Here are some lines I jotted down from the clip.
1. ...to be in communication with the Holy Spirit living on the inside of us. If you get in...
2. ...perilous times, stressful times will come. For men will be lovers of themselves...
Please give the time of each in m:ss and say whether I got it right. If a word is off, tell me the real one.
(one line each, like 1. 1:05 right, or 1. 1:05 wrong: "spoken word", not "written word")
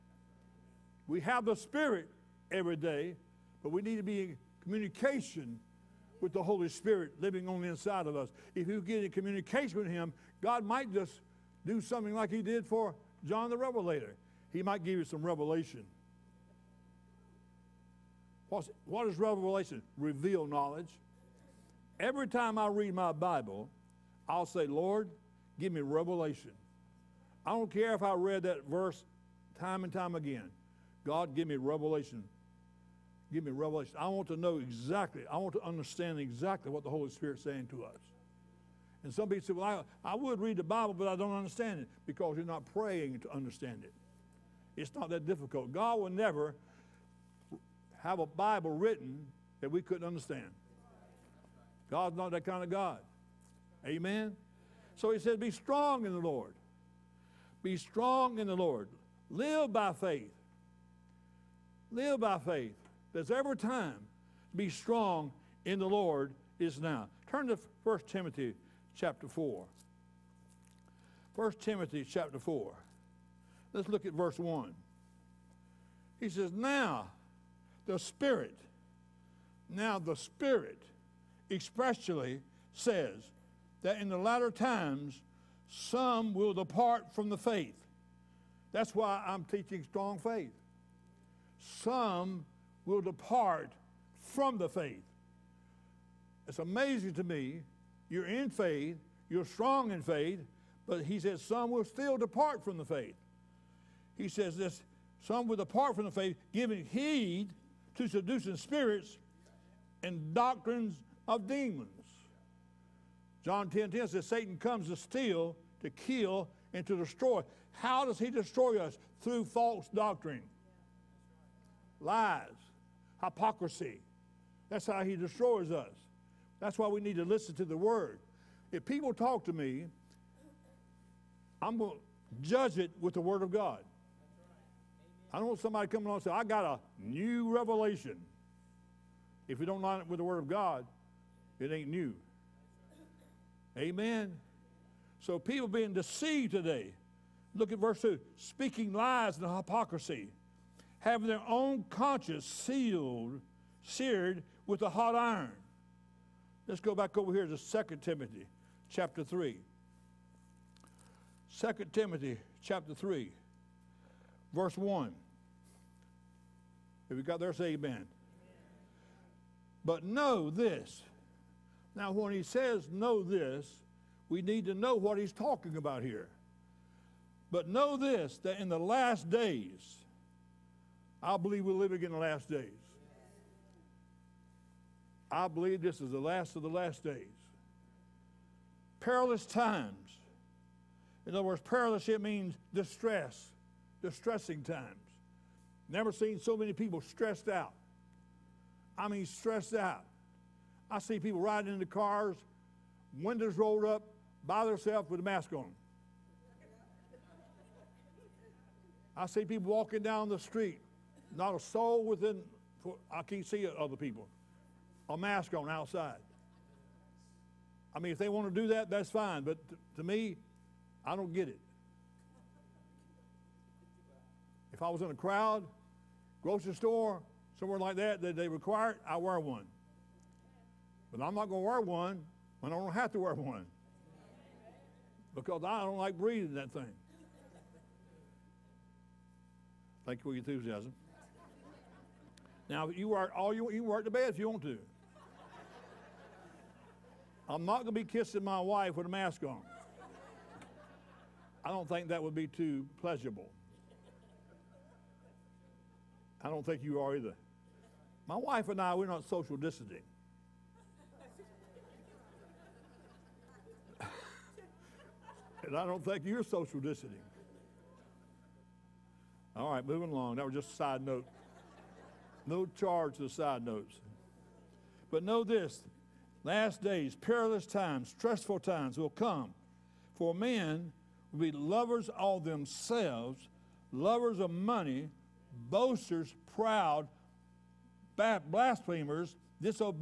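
1. 0:03 right
2. 4:37 right.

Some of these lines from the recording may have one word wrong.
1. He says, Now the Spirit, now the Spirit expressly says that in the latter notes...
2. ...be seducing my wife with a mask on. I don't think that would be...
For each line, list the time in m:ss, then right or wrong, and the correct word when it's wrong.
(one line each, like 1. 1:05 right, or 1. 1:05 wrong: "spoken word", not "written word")
1. 1:16 wrong: "times", not "notes"
2. 4:07 wrong: "kissing", not "seducing".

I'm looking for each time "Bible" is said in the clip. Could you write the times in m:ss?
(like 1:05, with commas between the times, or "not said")
0:23, 0:40, 0:48.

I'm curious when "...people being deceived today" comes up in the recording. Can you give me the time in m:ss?
2:25.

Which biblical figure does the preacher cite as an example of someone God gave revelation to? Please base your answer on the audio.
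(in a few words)
John the Revelator.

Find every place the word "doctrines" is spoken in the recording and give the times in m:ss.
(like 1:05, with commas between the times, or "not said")
1:50, 1:59.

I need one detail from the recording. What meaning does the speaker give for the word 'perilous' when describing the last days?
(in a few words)
distress.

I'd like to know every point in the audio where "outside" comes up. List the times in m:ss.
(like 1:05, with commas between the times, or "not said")
3:35.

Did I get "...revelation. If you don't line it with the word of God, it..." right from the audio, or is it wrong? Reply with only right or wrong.
right.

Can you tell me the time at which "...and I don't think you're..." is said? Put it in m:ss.
4:23.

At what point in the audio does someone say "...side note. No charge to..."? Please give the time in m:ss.
4:30.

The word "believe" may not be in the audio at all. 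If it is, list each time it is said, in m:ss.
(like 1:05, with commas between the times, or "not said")
3:01, 3:05.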